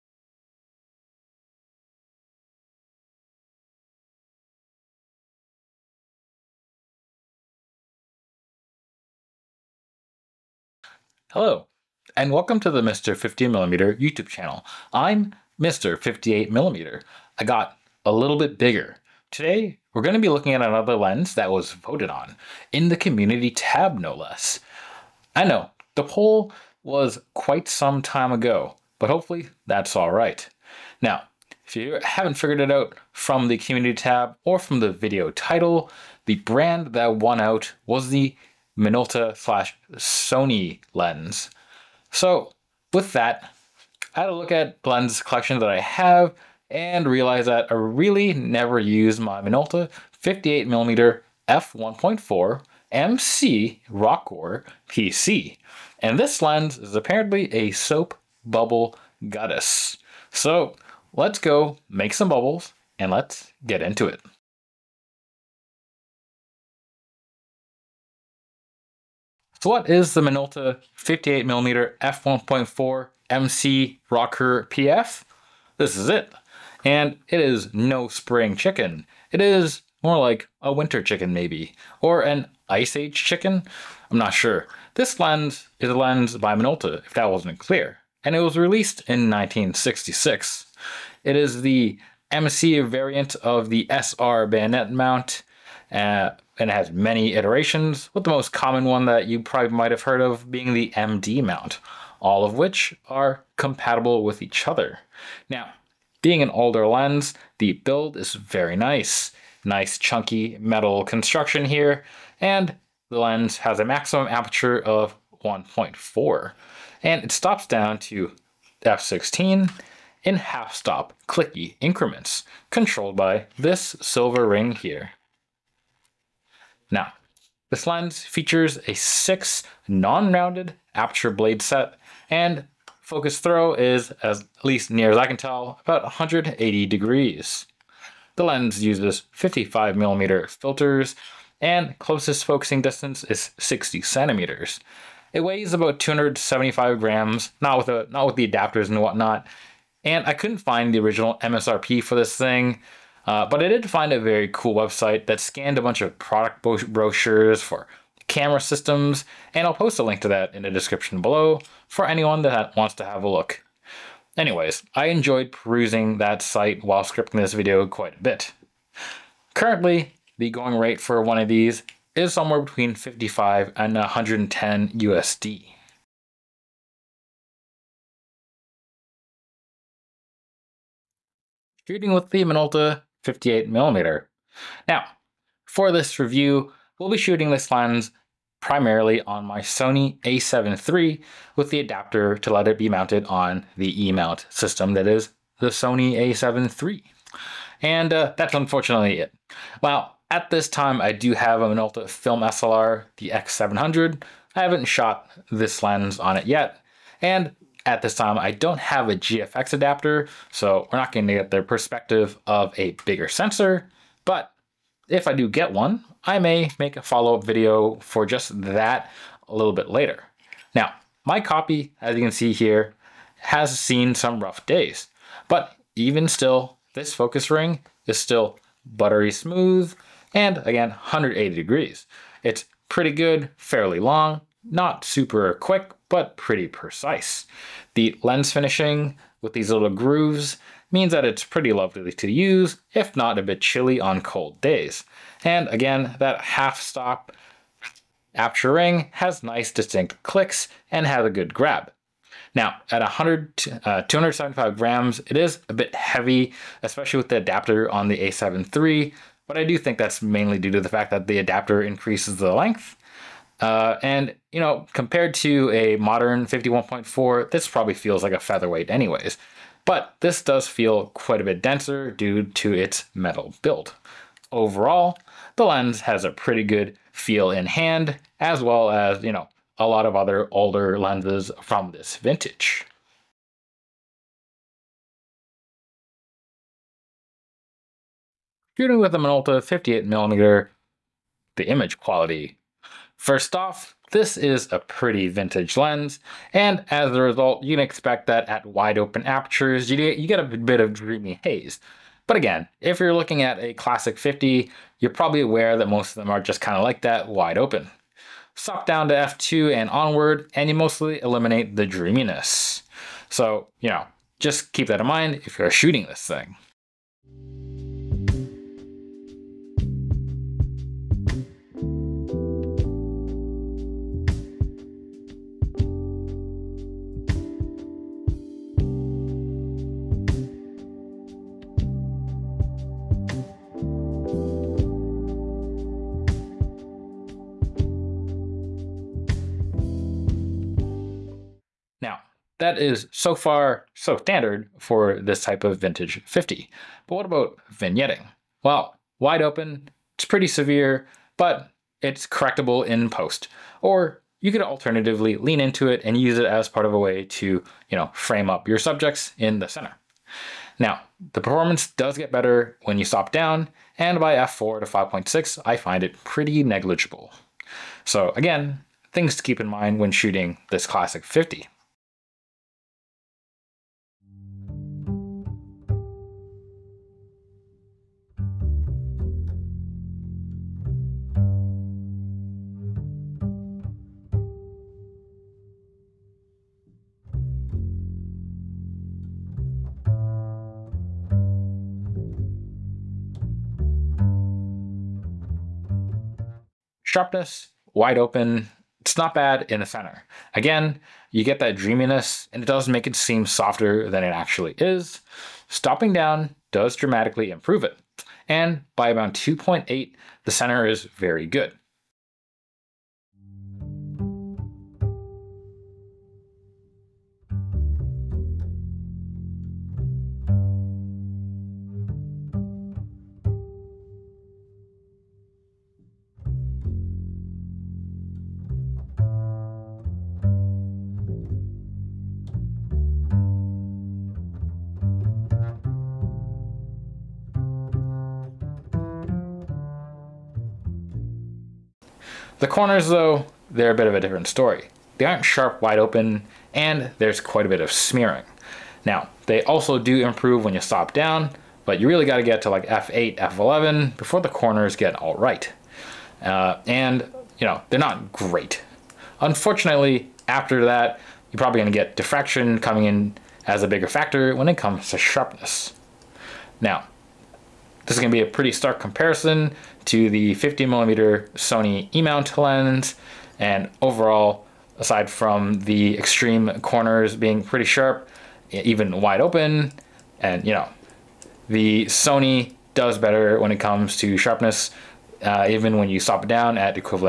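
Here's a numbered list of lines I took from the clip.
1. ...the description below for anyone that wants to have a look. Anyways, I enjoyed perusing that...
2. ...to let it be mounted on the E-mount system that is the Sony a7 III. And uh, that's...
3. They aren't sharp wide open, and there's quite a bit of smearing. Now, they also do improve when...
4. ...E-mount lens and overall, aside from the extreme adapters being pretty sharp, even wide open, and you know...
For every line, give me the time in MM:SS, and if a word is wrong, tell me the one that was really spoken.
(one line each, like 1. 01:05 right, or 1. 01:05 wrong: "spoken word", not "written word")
1. 02:40 right
2. 03:12 right
3. 07:25 right
4. 07:52 wrong: "corners", not "adapters".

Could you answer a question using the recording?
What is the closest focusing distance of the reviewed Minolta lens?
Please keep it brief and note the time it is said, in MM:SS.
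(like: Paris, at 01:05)
60 centimeters, at 02:23.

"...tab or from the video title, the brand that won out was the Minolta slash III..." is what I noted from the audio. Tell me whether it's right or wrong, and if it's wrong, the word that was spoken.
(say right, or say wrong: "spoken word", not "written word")
wrong: "Sony", not "III".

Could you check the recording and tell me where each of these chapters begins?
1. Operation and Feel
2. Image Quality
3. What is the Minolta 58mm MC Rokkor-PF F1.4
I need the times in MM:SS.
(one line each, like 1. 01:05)
1. 02:55
2. 04:44
3. 01:05.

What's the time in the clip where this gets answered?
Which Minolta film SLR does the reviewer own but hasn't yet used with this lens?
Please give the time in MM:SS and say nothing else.
03:23.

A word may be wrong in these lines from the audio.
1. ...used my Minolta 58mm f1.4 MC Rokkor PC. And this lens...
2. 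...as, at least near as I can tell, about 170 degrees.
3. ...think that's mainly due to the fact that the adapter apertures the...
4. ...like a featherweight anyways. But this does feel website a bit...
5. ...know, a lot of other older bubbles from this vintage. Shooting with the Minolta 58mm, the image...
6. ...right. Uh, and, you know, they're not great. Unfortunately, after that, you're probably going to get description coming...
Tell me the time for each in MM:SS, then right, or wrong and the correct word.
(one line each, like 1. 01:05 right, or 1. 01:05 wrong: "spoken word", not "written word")
1. 00:48 right
2. 02:14 wrong: "180", not "170"
3. 04:19 wrong: "increases", not "apertures"
4. 04:28 wrong: "quite", not "website"
5. 04:39 wrong: "lenses", not "bubbles"
6. 07:35 wrong: "diffraction", not "description".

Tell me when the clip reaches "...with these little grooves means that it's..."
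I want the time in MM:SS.
03:59.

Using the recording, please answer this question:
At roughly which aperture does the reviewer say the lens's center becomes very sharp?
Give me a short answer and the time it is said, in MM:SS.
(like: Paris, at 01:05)
f/2.8, at 06:49.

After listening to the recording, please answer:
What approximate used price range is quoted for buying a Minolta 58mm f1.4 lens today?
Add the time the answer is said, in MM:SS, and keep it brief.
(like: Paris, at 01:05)
55 to 110 USD, at 02:52.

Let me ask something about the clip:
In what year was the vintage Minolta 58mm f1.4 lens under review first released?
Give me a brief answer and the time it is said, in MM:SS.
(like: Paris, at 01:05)
1966, at 01:29.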